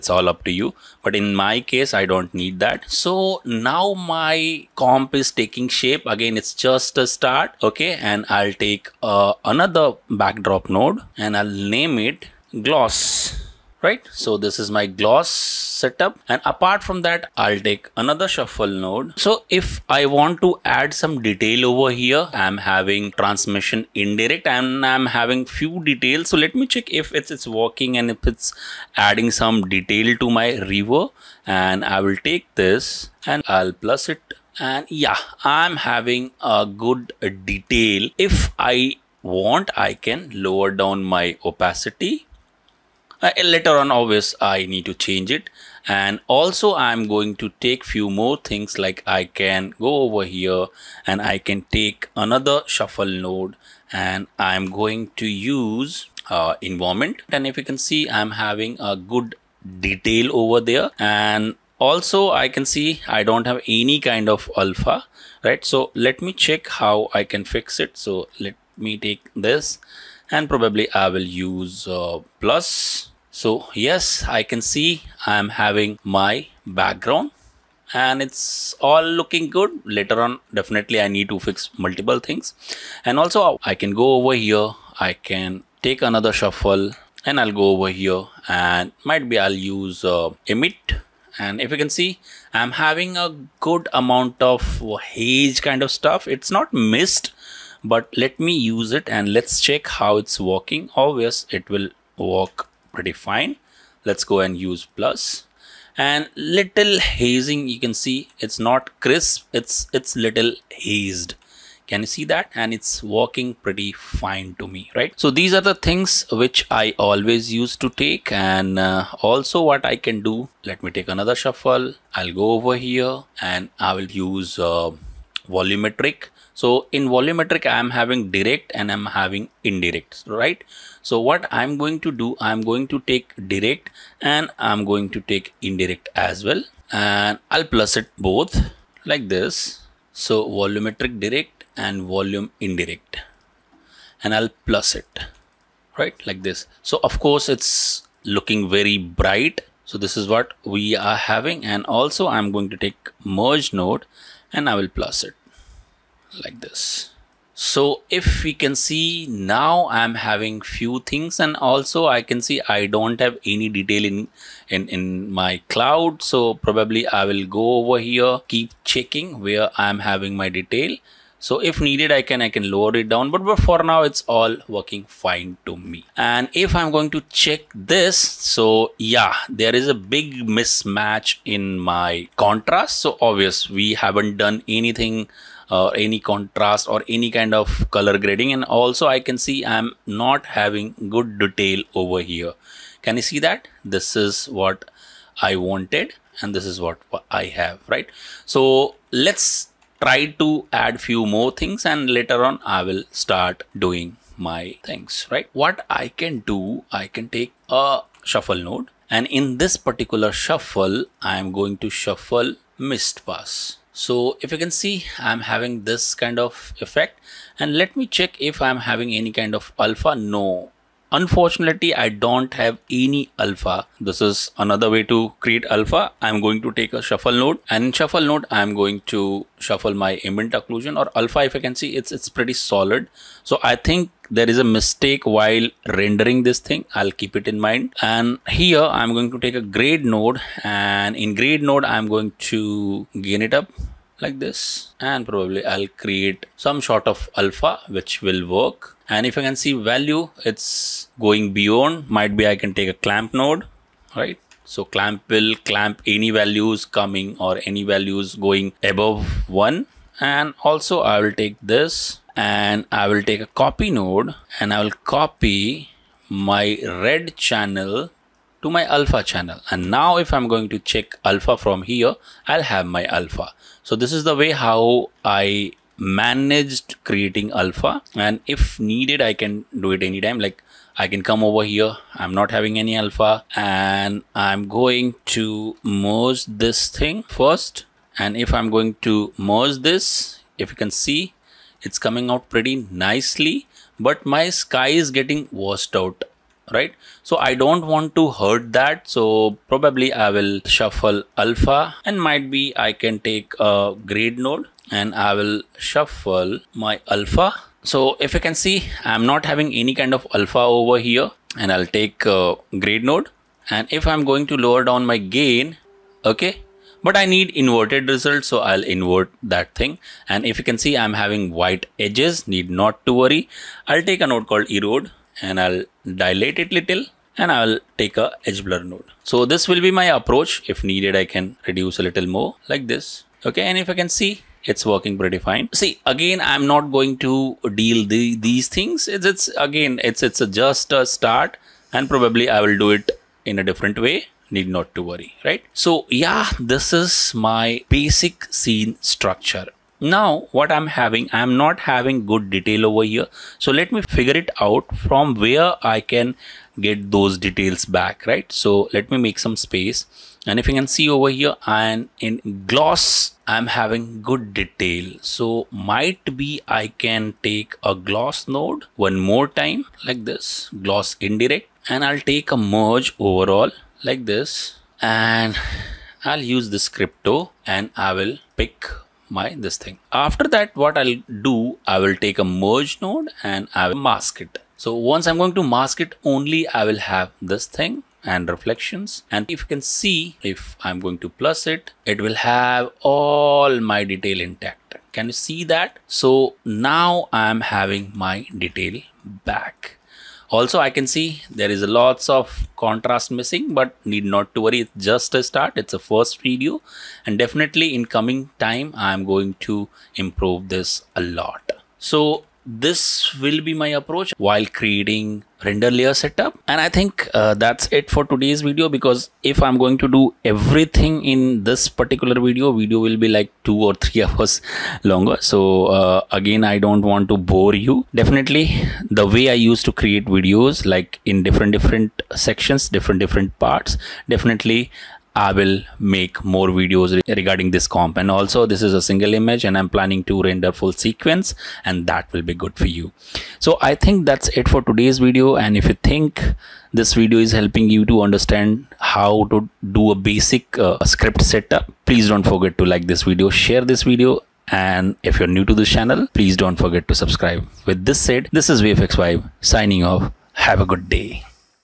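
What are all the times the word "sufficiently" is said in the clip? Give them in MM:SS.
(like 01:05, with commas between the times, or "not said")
not said.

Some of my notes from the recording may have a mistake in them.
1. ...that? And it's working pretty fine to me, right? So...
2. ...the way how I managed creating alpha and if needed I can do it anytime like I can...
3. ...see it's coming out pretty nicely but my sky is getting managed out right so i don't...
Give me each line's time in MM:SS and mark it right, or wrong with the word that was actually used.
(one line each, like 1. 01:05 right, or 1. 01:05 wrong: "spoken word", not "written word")
1. 01:52 right
2. 04:34 right
3. 04:50 wrong: "washed", not "managed".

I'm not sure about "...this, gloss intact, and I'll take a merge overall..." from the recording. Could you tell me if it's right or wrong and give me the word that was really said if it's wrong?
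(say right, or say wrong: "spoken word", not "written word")
wrong: "indirect", not "intact".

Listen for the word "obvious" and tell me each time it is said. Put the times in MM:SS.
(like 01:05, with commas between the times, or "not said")
01:40, 03:03.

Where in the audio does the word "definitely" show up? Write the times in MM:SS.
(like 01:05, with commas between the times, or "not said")
01:20, 06:47, 07:08, 07:14.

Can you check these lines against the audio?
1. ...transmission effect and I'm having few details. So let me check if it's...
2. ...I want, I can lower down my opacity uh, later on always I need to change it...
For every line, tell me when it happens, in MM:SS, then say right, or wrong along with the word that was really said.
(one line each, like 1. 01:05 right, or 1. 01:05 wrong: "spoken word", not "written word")
1. 00:23 wrong: "indirect", not "effect"
2. 00:38 right.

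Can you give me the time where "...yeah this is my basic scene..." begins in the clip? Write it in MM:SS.
05:46.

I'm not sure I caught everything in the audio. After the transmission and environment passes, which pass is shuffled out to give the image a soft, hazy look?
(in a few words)
Emit.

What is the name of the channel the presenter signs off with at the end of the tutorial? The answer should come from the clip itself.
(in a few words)
VFX Vibe.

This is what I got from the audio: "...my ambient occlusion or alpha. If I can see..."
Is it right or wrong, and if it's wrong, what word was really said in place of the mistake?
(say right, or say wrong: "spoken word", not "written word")
right.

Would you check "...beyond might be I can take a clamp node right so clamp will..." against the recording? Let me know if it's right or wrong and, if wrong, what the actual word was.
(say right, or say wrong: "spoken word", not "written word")
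right.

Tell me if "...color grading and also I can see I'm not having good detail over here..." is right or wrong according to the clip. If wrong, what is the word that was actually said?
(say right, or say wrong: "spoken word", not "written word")
right.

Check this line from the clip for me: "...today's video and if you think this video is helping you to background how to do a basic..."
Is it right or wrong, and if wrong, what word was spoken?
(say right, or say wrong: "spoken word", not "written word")
wrong: "understand", not "background".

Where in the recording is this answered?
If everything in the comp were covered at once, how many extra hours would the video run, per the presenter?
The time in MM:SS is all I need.
07:03.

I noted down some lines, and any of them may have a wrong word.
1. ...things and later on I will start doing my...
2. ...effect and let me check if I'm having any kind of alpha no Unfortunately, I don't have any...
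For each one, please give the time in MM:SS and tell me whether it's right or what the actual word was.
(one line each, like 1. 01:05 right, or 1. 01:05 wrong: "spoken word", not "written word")
1. 03:21 right
2. 03:36 right.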